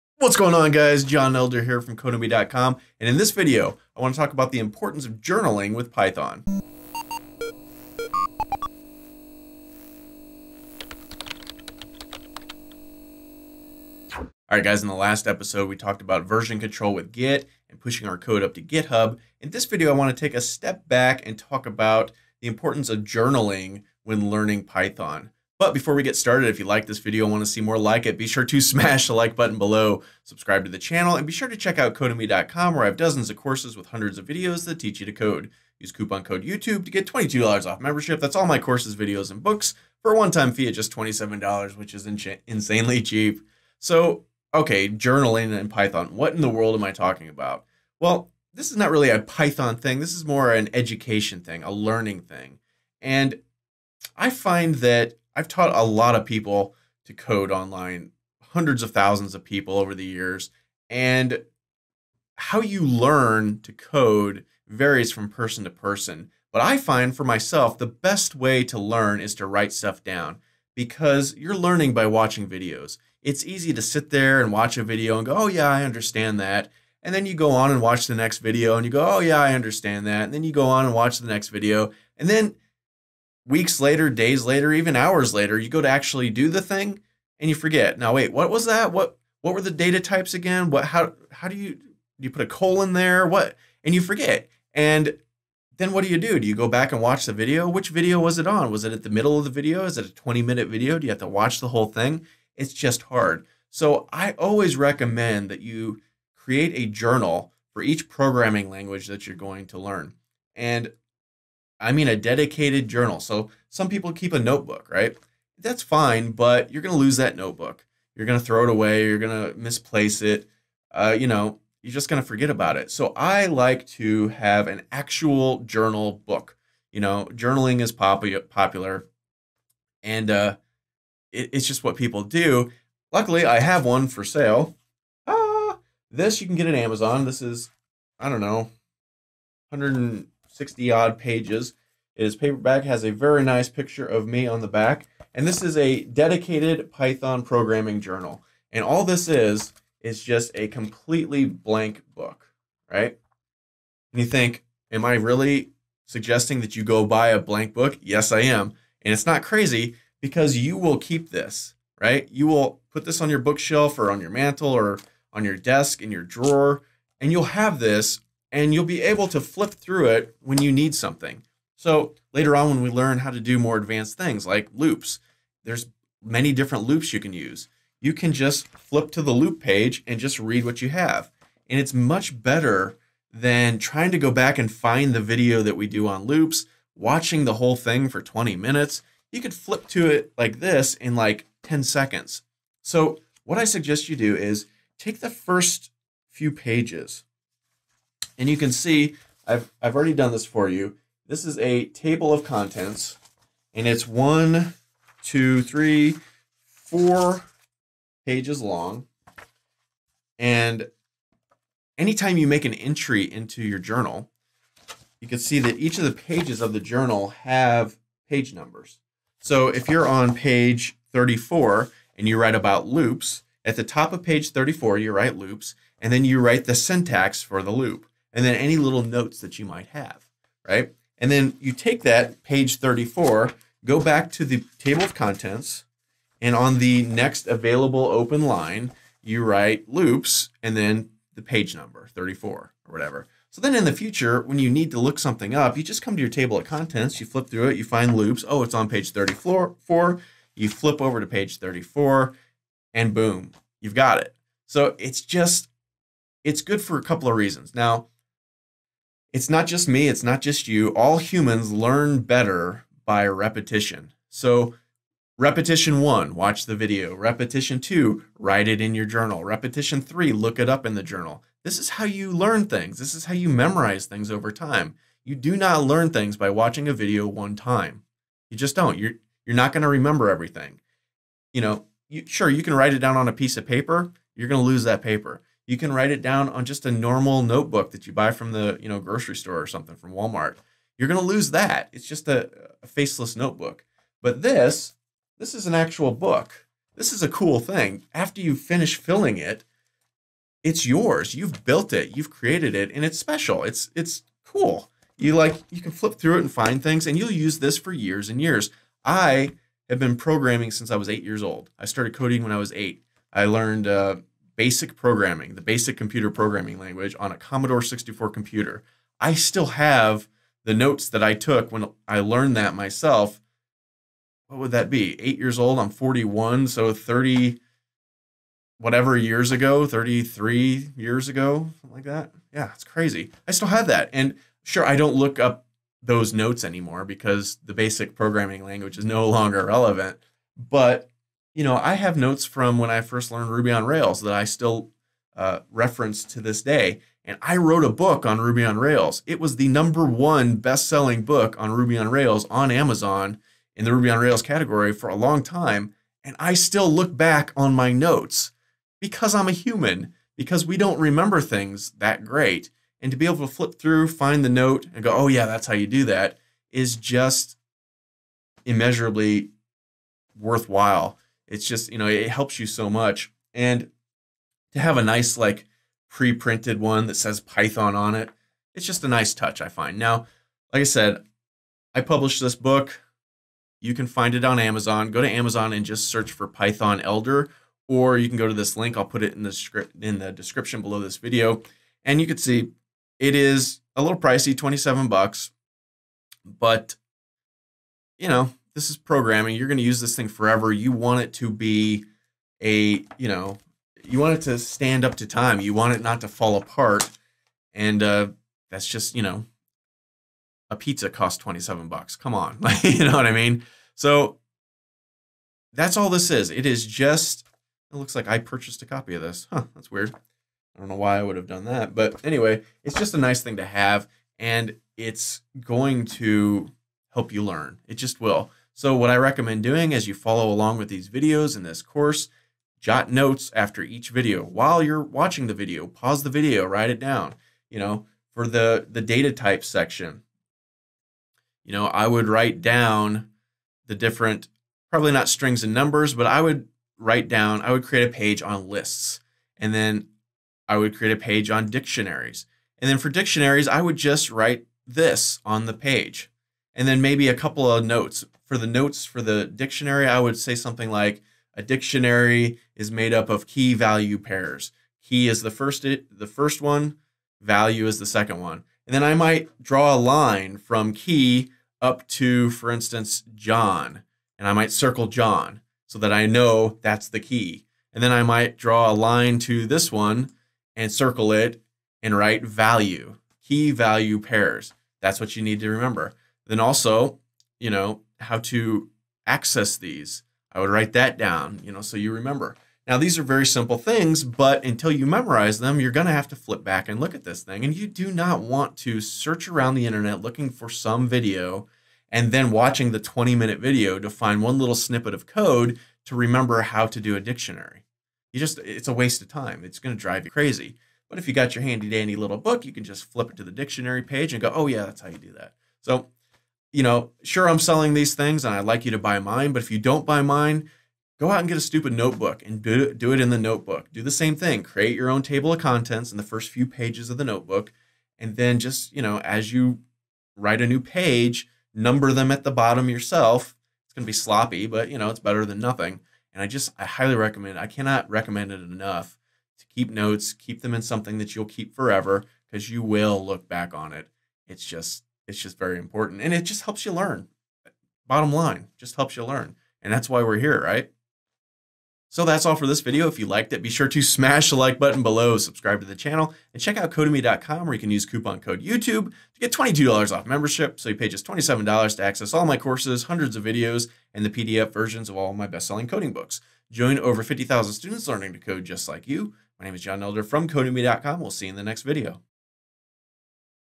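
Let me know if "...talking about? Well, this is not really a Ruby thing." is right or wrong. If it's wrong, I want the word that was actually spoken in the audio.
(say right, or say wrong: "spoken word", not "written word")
wrong: "Python", not "Ruby".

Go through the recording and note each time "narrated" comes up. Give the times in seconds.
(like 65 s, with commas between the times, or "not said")
not said.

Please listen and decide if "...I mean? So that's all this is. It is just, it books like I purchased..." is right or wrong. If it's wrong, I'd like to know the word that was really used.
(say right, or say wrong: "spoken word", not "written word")
wrong: "looks", not "books".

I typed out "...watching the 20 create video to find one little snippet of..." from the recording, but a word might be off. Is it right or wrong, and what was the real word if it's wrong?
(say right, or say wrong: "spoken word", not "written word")
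wrong: "minute", not "create".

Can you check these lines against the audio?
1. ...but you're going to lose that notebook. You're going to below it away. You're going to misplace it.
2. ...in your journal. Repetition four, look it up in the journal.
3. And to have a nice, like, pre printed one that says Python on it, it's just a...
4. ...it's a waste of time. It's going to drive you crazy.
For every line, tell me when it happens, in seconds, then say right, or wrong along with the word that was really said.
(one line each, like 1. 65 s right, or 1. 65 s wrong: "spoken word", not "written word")
1. 116 s wrong: "throw", not "below"
2. 268 s wrong: "three", not "four"
3. 373 s right
4. 508 s right.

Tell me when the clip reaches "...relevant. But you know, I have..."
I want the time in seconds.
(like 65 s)
339 s.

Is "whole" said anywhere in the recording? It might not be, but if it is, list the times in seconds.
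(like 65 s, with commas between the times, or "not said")
101 s, 187 s.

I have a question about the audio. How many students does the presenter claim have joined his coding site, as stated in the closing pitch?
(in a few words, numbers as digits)
50,000.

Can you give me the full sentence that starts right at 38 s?
That's all my courses, videos, and books for a one-time fee at just $27, which is insanely cheap.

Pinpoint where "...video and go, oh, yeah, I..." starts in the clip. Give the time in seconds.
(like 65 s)
74 s.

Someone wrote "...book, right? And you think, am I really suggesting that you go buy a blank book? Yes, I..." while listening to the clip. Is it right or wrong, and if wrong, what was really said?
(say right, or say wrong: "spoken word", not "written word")
right.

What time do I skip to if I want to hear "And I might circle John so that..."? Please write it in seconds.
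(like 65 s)
474 s.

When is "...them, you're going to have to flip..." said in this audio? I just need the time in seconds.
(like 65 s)
495 s.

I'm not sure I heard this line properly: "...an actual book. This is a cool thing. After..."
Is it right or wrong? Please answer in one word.
right.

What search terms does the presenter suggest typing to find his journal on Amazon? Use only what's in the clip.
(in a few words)
Python Elder.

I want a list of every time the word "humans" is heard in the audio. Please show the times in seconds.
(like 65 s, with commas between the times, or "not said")
261 s, 359 s.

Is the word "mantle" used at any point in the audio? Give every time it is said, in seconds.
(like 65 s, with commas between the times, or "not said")
164 s.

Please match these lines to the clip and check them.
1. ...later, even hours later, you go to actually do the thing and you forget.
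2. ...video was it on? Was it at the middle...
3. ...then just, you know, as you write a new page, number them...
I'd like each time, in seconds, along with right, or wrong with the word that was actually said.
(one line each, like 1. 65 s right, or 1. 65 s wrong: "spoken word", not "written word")
1. 84 s right
2. 97 s right
3. 528 s right.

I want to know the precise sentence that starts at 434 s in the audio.
While you're watching the video, pause the video, write it down.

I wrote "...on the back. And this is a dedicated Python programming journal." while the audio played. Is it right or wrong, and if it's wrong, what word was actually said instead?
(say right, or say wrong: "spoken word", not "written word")
right.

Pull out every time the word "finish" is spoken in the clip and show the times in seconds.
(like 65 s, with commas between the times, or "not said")
298 s.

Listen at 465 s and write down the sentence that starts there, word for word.
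Key is the first the first one, value is the second one.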